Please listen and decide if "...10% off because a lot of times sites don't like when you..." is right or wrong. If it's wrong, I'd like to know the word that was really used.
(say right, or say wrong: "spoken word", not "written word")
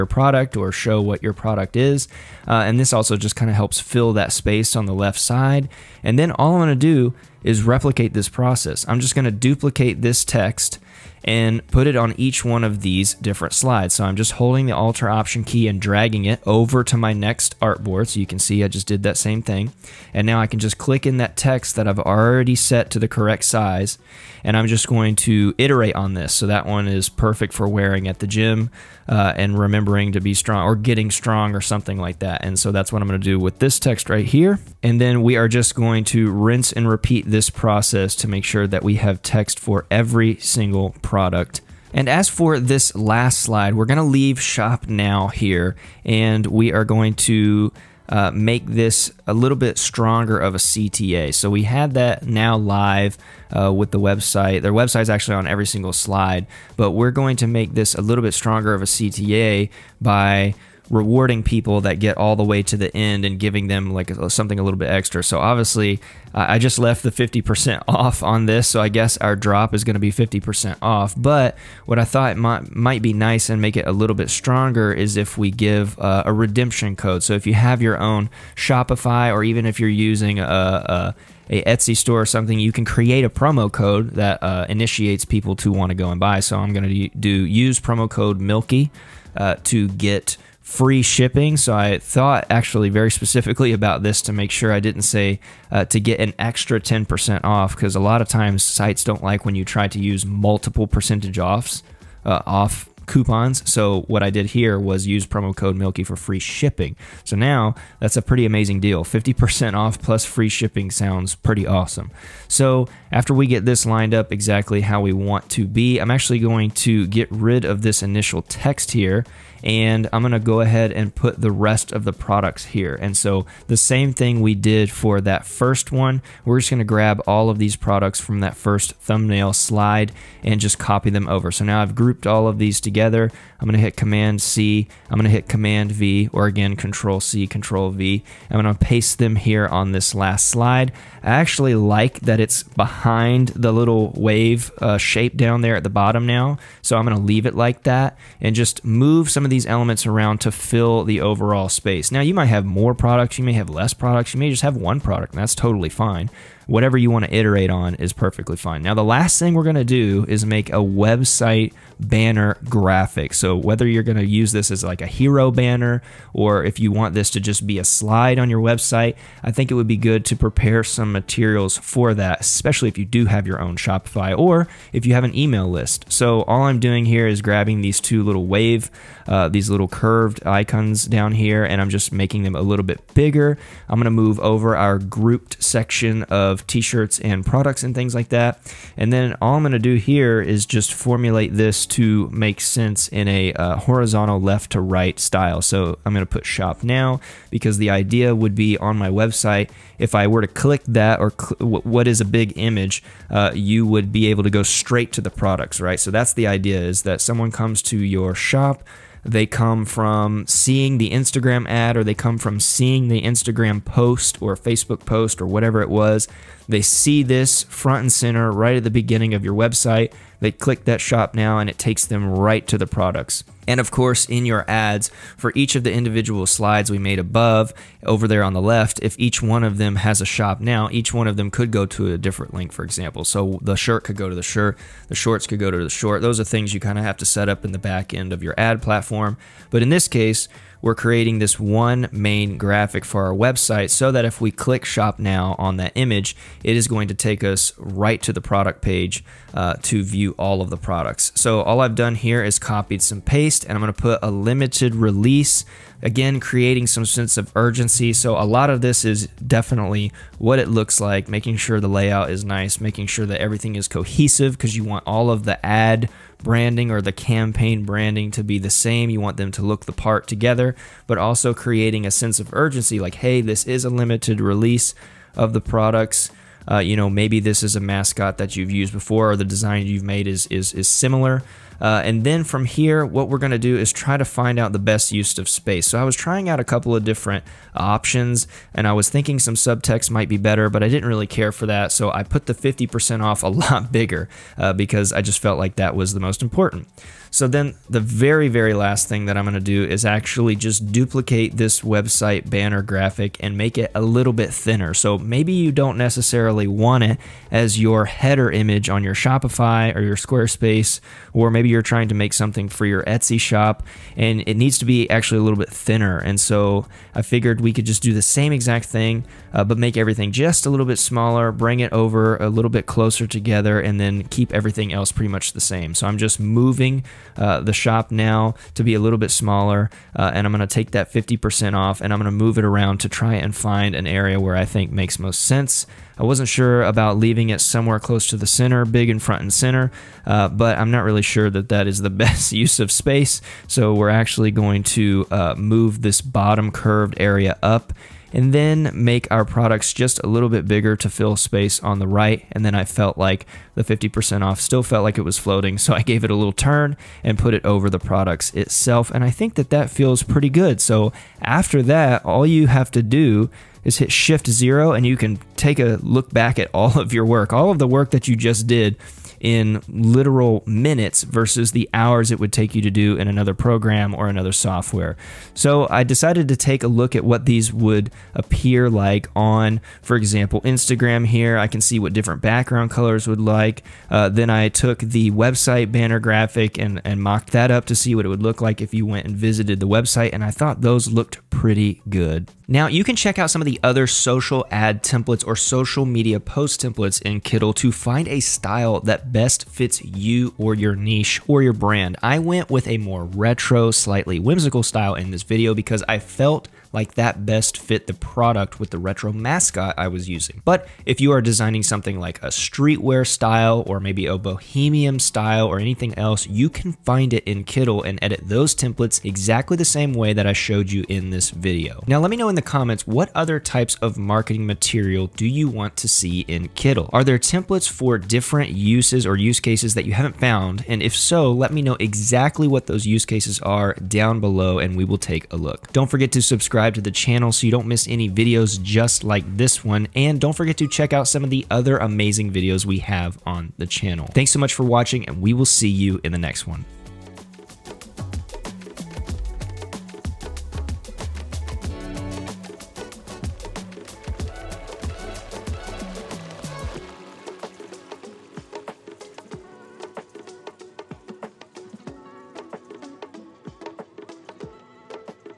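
right.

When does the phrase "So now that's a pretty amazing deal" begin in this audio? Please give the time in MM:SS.
01:47.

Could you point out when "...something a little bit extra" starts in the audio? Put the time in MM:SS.
01:04.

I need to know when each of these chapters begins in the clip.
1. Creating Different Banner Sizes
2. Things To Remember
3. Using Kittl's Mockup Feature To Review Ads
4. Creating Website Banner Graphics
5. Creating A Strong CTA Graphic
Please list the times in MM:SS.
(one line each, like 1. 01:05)
1. 05:12
2. 06:32
3. 06:12
4. 02:37
5. 00:42.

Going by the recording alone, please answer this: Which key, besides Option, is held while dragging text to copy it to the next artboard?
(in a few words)
Alt.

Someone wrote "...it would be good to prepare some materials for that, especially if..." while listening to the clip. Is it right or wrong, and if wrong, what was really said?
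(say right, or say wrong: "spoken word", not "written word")
right.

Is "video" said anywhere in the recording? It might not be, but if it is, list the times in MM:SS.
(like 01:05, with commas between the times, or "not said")
06:45, 07:01, 07:18, 07:22.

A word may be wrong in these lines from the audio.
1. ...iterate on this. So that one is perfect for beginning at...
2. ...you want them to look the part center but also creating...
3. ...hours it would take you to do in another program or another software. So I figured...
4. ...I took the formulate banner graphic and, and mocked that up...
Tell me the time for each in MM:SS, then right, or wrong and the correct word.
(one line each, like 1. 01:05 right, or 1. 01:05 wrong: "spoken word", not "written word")
1. 00:25 wrong: "wearing", not "beginning"
2. 04:29 wrong: "together", not "center"
3. 06:11 wrong: "decided", not "figured"
4. 06:24 wrong: "website", not "formulate".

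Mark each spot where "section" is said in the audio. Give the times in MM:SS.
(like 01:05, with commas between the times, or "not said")
03:05.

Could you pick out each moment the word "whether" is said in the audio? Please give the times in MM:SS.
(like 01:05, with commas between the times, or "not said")
02:43.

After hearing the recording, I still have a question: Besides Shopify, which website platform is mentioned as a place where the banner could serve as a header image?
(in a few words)
Squarespace.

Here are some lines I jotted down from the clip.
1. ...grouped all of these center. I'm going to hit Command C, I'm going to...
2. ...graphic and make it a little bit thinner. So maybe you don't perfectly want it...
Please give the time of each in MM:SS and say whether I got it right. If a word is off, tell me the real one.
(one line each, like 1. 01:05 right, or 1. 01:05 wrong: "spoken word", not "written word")
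1. 02:11 wrong: "together", not "center"
2. 05:02 wrong: "necessarily", not "perfectly".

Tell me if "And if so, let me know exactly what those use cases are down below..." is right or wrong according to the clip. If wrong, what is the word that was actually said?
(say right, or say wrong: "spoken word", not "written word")
right.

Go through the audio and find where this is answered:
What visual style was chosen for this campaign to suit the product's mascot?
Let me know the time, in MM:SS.
06:43.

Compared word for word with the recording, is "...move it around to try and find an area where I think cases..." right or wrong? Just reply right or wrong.
wrong.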